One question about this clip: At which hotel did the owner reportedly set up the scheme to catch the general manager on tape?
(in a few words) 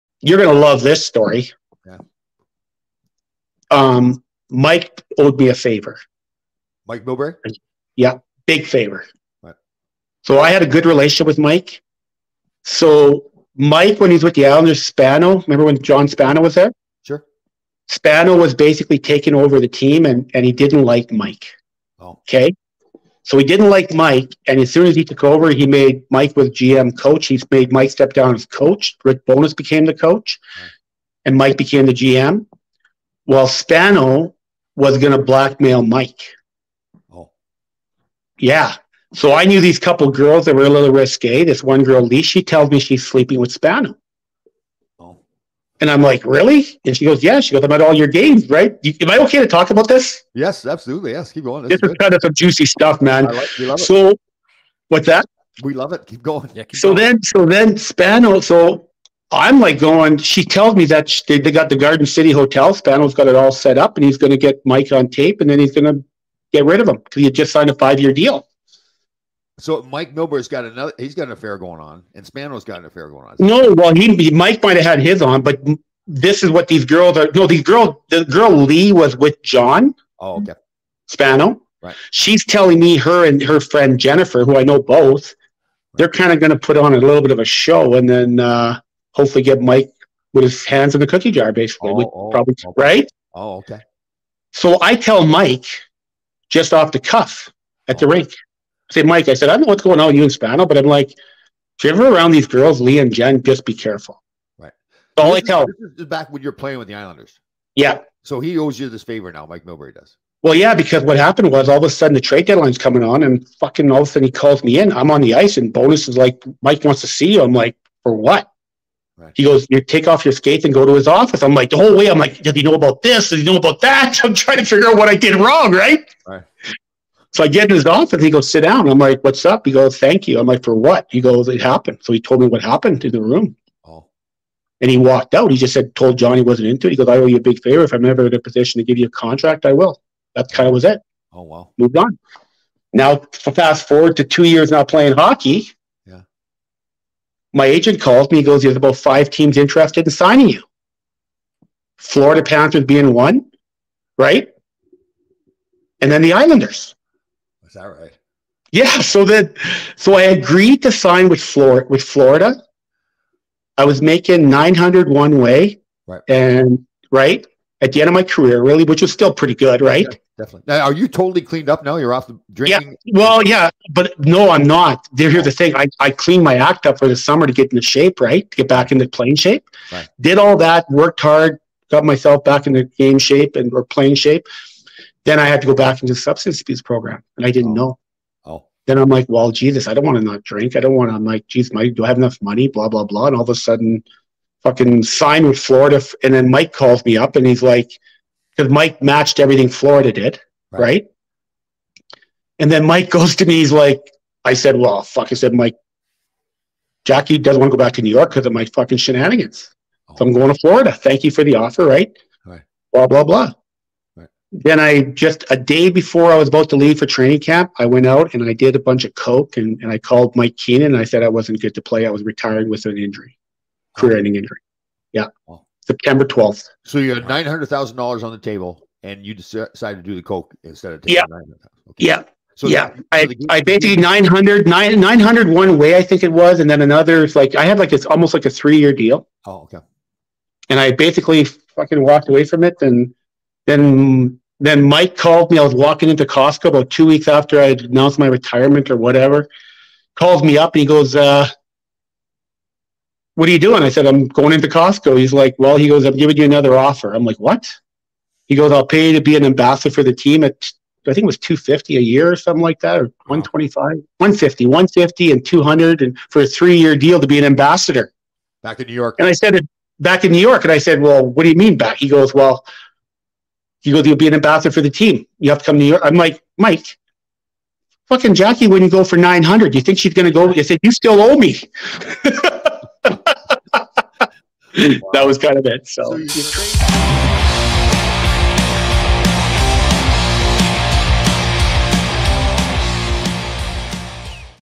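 Garden City Hotel.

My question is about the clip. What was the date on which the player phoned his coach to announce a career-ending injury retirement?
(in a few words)
September 12.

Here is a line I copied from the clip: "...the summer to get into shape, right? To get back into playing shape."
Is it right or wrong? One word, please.
right.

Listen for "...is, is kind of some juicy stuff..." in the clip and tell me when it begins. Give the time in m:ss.
0:51.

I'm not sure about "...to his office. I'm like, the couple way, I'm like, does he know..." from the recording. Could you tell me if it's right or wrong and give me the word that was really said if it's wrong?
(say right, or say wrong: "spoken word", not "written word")
wrong: "whole", not "couple".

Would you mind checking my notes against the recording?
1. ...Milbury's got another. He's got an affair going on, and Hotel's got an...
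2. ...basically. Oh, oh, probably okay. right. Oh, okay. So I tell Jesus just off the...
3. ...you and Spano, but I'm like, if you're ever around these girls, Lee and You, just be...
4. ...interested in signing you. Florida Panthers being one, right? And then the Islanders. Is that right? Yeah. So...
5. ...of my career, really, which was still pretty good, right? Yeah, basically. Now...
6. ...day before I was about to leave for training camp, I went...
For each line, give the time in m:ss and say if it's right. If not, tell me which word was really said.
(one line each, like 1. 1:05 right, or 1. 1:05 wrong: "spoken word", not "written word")
1. 1:10 wrong: "Spano", not "Hotel"
2. 1:31 wrong: "Mike", not "Jesus"
3. 1:40 wrong: "Jen", not "You"
4. 2:29 right
5. 2:48 wrong: "definitely", not "basically"
6. 3:35 right.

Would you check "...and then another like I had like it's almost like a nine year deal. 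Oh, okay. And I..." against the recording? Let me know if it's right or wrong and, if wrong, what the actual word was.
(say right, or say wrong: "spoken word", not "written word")
wrong: "three", not "nine".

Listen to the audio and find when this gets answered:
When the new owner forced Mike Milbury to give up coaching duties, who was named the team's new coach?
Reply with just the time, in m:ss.
0:29.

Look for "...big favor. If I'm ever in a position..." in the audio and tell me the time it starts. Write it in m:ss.
2:17.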